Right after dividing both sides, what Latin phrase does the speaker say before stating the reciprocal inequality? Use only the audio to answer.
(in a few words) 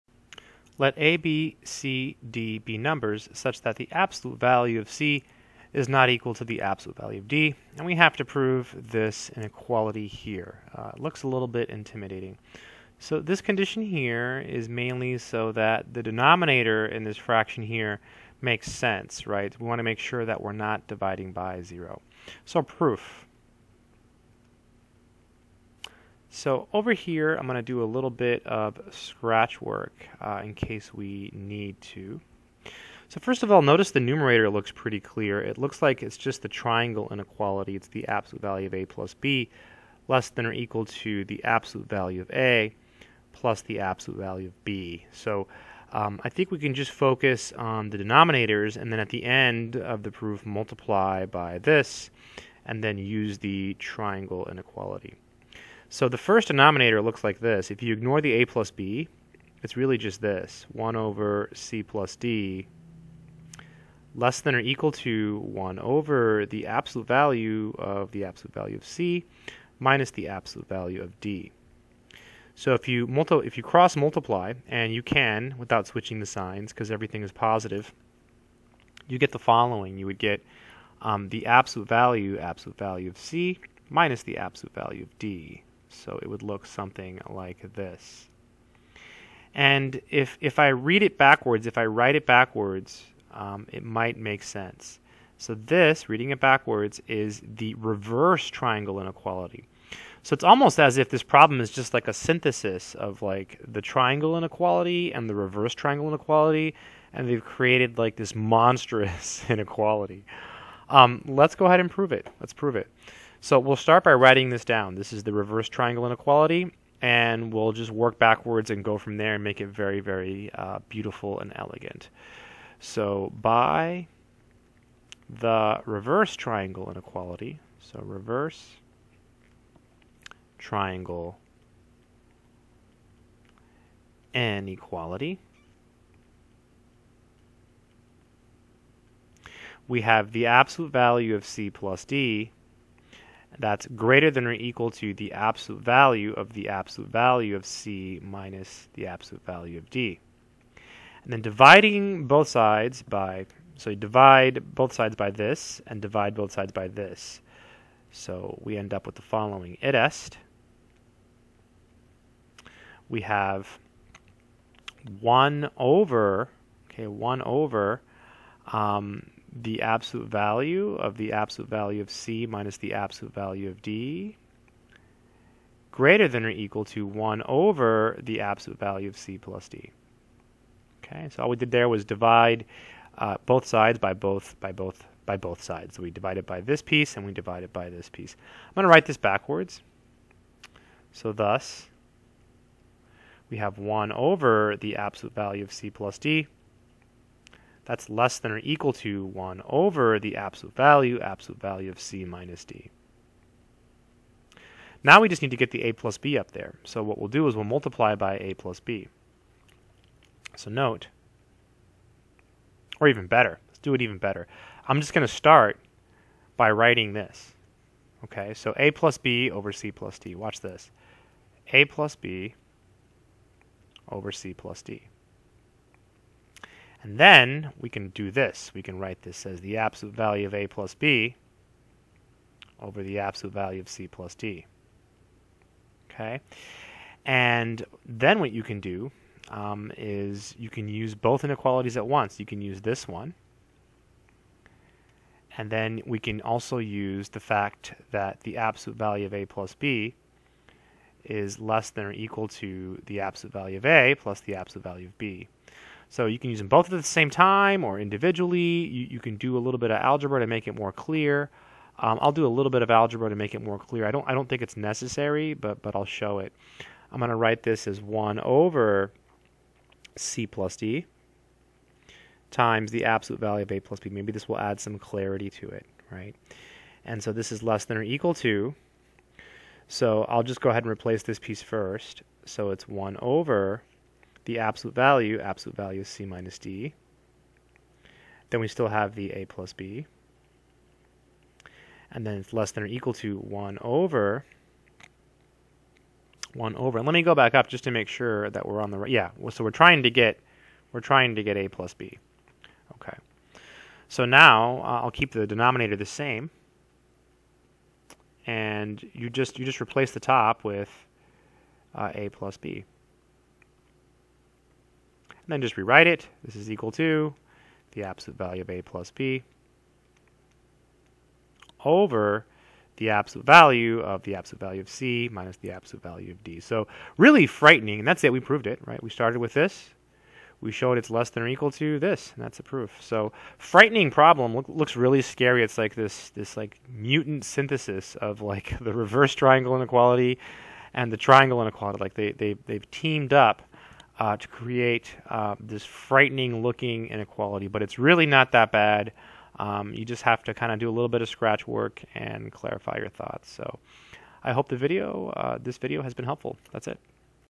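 Id est.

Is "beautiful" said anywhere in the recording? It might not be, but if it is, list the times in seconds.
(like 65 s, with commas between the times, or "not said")
120 s.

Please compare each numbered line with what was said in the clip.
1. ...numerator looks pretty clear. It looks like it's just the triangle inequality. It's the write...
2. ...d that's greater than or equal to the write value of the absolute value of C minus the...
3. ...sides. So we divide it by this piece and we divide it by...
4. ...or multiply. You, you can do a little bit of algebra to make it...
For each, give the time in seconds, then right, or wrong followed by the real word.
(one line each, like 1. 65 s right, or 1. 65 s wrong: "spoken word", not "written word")
1. 33 s wrong: "absolute", not "write"
2. 142 s wrong: "absolute", not "write"
3. 185 s right
4. 257 s wrong: "individually", not "multiply".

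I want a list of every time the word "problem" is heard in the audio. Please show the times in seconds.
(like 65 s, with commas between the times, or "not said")
101 s, 334 s.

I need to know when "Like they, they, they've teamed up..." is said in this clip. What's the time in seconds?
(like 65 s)
341 s.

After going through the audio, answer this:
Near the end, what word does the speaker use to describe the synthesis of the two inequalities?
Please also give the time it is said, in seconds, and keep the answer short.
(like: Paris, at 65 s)
Mutant, at 336 s.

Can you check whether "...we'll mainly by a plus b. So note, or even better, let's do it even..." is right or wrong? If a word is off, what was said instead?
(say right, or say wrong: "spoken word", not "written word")
wrong: "multiply", not "mainly".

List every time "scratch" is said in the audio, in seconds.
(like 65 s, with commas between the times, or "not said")
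28 s, 351 s.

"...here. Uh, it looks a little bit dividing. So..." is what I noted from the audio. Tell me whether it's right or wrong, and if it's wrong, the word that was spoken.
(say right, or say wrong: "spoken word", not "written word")
wrong: "intimidating", not "dividing".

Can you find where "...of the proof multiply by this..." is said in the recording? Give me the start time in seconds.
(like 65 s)
49 s.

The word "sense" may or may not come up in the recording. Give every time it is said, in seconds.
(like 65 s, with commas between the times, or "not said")
18 s, 94 s.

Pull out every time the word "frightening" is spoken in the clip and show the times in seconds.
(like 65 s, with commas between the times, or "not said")
327 s, 333 s, 345 s.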